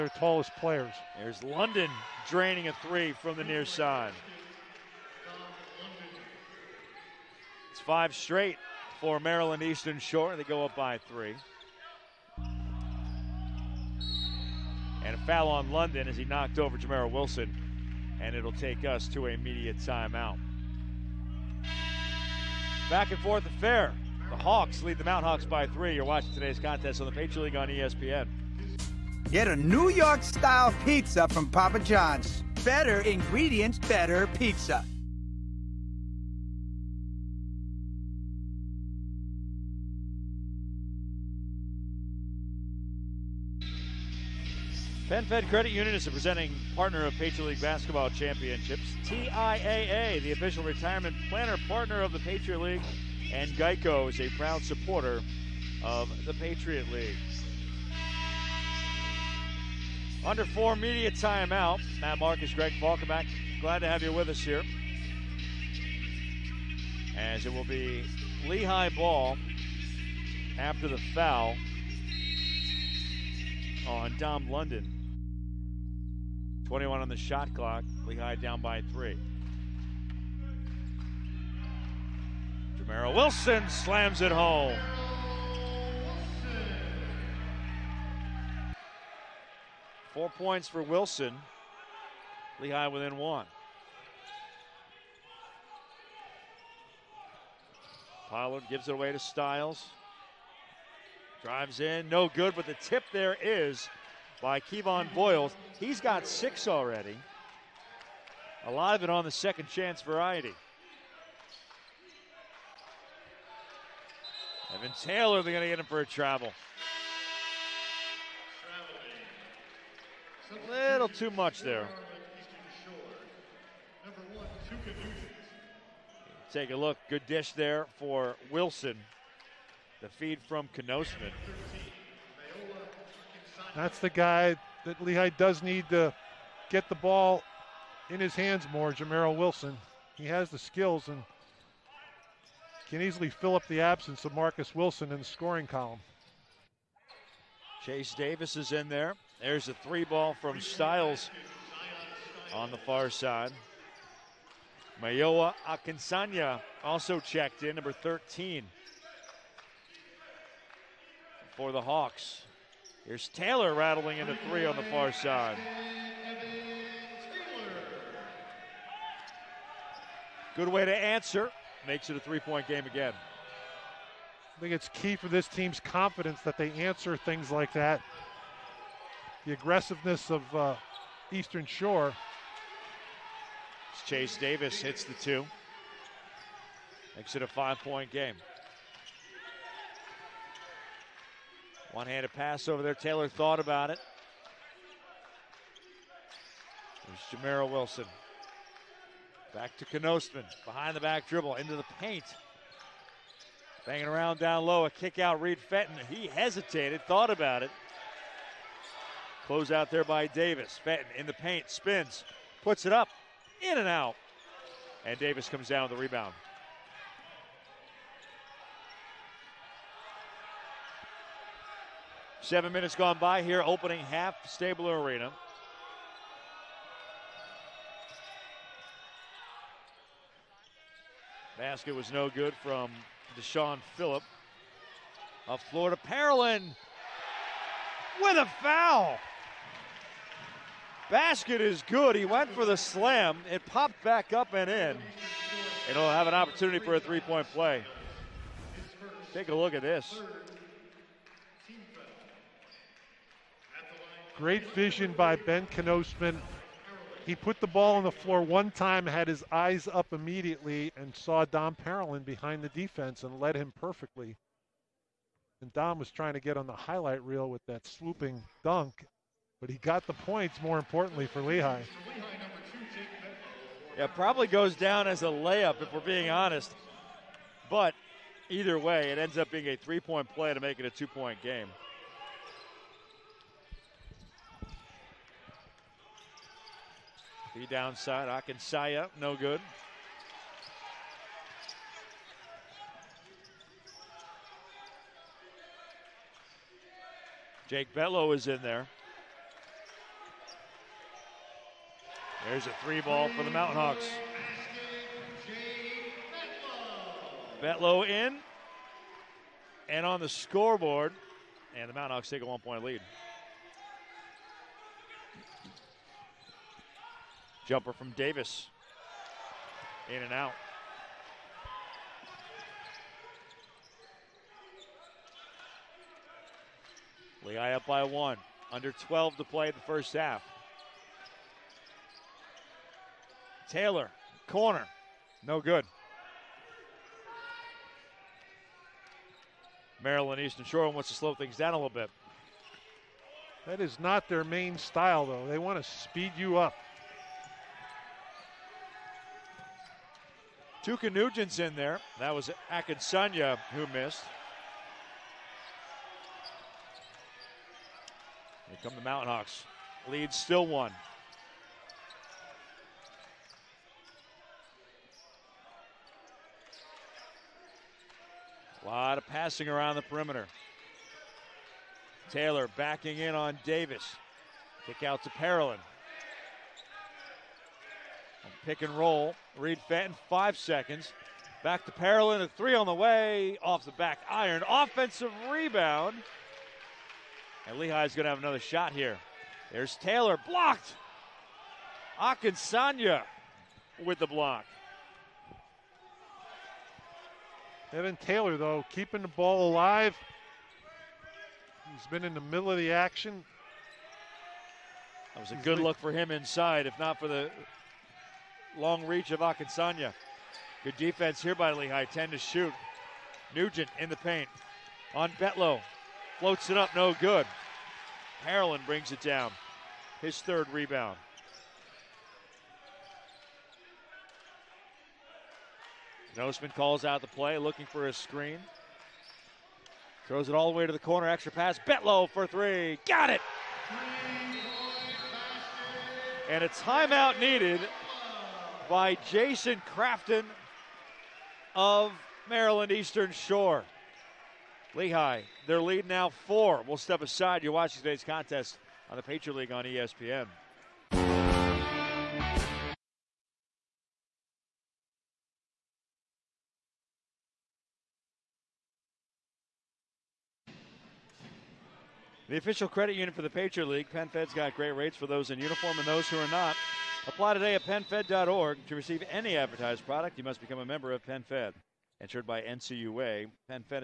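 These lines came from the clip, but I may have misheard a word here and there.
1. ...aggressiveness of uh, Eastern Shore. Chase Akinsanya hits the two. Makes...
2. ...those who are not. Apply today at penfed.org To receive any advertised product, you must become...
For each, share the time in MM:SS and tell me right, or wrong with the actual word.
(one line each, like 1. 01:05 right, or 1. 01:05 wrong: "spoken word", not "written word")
1. 02:59 wrong: "Davis", not "Akinsanya"
2. 07:46 right.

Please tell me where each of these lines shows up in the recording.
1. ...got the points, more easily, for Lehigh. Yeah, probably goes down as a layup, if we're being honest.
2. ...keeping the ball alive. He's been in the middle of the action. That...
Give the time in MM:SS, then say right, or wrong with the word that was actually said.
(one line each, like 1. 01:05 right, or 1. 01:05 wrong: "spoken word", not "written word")
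1. 04:29 wrong: "importantly", not "easily"
2. 06:38 right.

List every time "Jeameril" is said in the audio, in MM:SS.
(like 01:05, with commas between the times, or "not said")
00:16, 01:22, 02:18, 03:17.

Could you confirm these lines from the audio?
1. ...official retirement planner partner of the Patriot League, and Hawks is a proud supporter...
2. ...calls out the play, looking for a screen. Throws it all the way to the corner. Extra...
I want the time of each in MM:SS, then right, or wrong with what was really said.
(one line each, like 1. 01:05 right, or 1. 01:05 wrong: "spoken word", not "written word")
1. 00:50 wrong: "Geico", not "Hawks"
2. 07:06 right.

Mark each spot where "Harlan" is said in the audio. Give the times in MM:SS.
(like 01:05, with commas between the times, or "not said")
06:58.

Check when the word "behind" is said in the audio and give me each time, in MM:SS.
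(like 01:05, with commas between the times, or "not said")
03:20, 04:22.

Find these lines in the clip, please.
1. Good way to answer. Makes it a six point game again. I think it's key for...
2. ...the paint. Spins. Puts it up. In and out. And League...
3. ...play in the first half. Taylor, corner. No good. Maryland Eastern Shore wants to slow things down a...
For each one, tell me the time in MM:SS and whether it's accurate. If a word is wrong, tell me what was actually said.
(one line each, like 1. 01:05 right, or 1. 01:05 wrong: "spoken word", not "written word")
1. 02:50 wrong: "three", not "six"
2. 03:31 wrong: "Davis", not "League"
3. 05:29 right.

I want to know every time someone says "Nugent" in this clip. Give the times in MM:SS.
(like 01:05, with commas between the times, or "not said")
05:51, 06:53.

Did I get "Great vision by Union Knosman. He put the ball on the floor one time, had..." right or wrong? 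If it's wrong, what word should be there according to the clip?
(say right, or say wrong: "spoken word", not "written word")
wrong: "Ben", not "Union".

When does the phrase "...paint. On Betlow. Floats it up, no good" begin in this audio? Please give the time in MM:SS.
06:54.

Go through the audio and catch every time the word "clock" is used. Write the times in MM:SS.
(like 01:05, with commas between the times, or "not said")
01:17.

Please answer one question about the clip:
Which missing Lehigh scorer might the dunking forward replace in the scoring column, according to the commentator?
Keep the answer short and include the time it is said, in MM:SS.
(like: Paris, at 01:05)
Marcus Wilson, at 02:24.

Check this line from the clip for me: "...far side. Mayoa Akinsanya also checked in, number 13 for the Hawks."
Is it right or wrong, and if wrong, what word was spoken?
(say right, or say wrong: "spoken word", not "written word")
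right.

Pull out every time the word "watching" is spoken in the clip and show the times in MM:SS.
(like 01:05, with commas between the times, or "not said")
00:26, 07:27.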